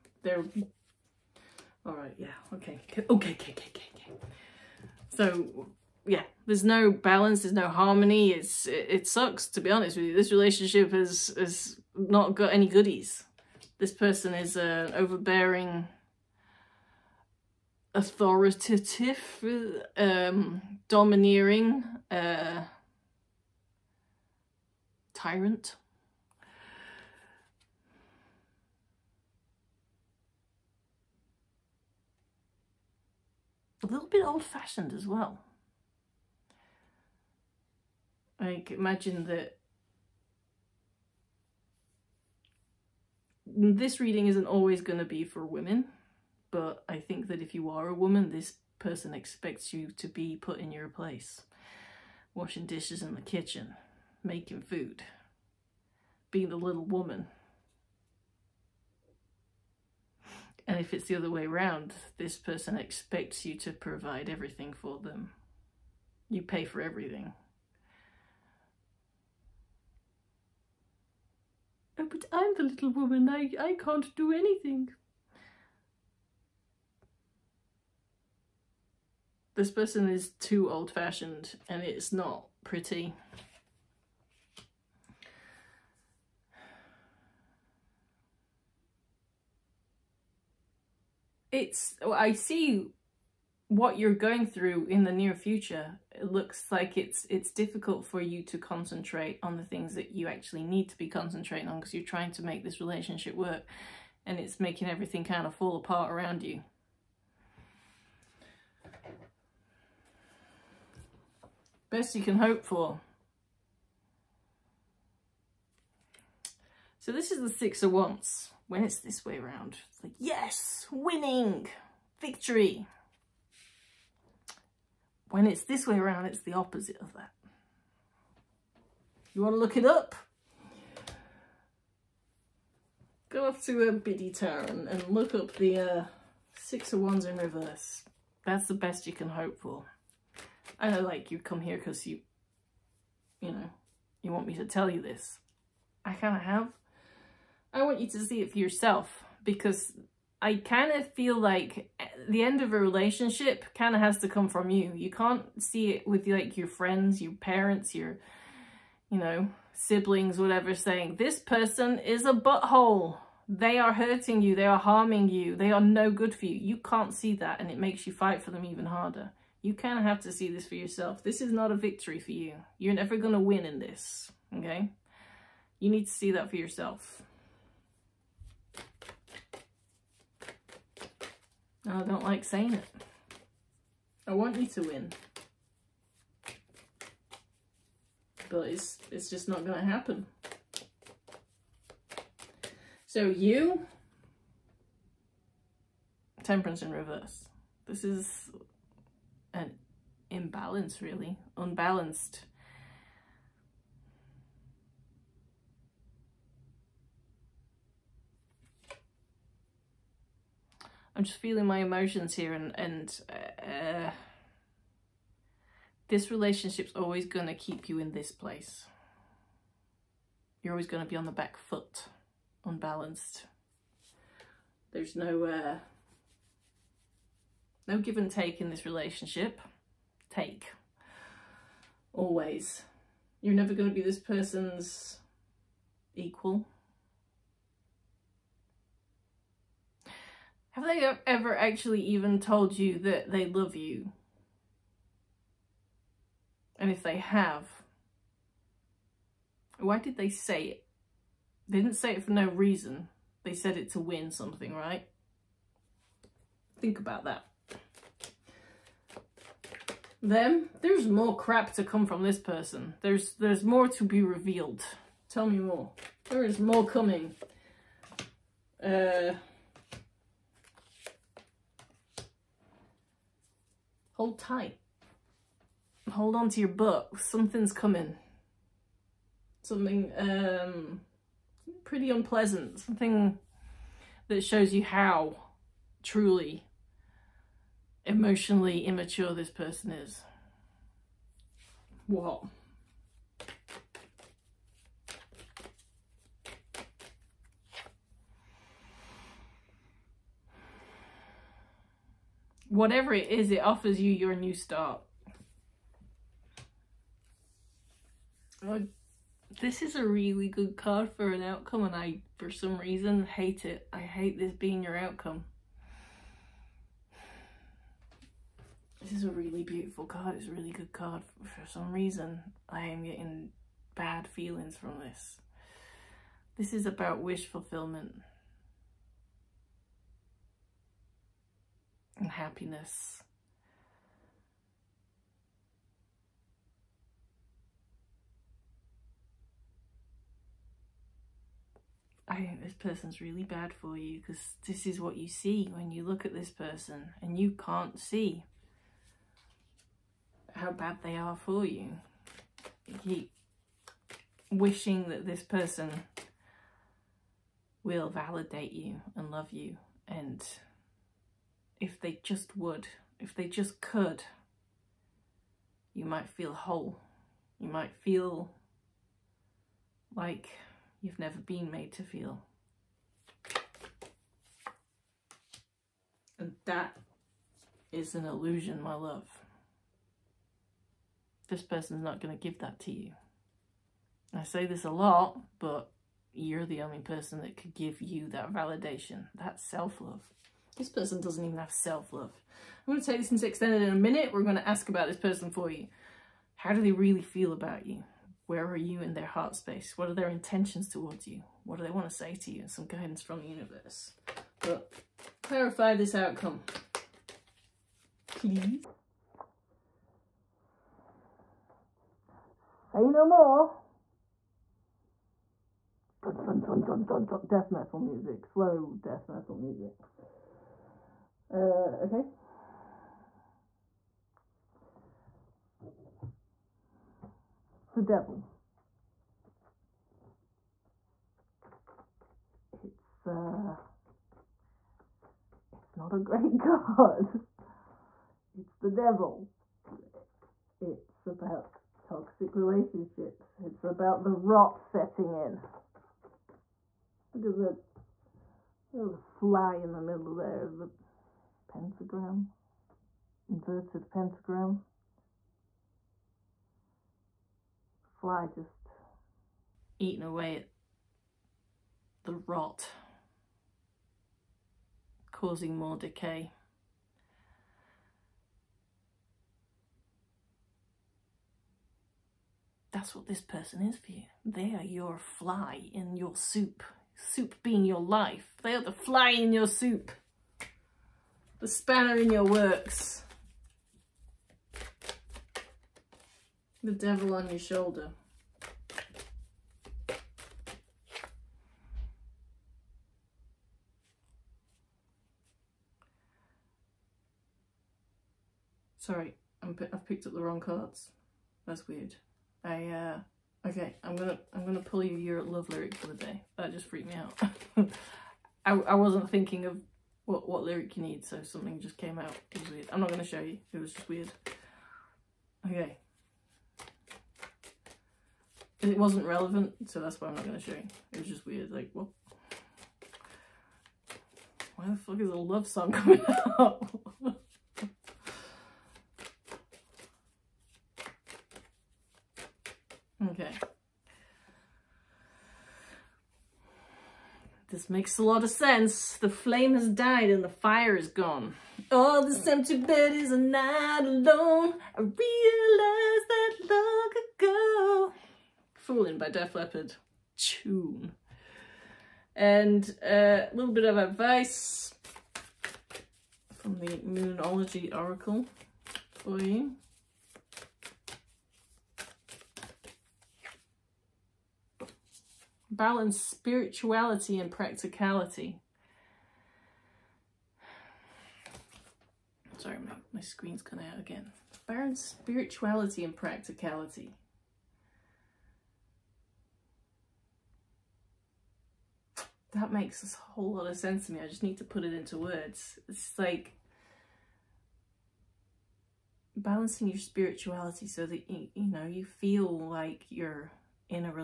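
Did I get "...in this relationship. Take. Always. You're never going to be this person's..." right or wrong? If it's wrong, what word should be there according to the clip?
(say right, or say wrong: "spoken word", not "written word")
right.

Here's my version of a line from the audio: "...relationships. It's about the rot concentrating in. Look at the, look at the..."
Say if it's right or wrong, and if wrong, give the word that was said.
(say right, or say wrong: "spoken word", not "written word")
wrong: "setting", not "concentrating".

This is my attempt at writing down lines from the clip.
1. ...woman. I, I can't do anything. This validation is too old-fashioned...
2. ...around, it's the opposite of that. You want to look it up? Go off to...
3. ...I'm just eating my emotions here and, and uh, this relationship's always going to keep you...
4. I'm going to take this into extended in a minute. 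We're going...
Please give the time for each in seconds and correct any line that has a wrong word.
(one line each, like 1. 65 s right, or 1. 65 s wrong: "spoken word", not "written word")
1. 72 s wrong: "person", not "validation"
2. 125 s right
3. 211 s wrong: "feeling", not "eating"
4. 392 s right.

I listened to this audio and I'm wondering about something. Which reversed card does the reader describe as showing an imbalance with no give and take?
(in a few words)
Temperance.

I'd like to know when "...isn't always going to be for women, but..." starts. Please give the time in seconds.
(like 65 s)
44 s.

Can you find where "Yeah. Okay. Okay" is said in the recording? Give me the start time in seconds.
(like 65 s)
2 s.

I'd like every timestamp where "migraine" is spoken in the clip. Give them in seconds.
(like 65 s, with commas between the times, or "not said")
not said.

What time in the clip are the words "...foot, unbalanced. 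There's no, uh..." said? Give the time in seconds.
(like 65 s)
221 s.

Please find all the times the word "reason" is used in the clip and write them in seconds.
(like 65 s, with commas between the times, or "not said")
252 s, 312 s, 321 s.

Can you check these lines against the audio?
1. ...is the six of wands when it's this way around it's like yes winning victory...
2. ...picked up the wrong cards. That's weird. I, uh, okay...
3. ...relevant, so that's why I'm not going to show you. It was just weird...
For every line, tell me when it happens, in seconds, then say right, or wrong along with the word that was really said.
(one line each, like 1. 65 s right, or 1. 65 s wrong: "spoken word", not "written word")
1. 117 s right
2. 500 s right
3. 519 s right.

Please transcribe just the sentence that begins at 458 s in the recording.
Fly just eating away at the rot, causing more decay.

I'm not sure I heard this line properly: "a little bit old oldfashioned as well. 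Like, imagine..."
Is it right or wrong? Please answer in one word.
wrong.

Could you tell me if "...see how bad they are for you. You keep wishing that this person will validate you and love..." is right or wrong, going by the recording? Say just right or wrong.
right.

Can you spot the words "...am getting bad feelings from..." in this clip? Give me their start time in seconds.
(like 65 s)
322 s.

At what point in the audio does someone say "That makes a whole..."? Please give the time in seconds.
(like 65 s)
582 s.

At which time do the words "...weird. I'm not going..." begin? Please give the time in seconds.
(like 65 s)
512 s.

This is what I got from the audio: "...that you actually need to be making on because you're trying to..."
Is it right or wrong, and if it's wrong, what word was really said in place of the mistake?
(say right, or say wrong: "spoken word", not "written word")
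wrong: "concentrating", not "making".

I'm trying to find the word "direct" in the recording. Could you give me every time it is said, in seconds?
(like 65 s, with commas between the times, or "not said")
not said.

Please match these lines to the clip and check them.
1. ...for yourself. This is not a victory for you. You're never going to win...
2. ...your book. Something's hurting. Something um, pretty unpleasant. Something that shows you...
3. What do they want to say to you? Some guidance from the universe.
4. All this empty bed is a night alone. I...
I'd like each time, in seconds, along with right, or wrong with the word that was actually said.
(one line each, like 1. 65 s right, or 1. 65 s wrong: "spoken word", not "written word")
1. 170 s right
2. 276 s wrong: "coming", not "hurting"
3. 401 s right
4. 541 s right.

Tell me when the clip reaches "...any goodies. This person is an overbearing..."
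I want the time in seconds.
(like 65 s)
12 s.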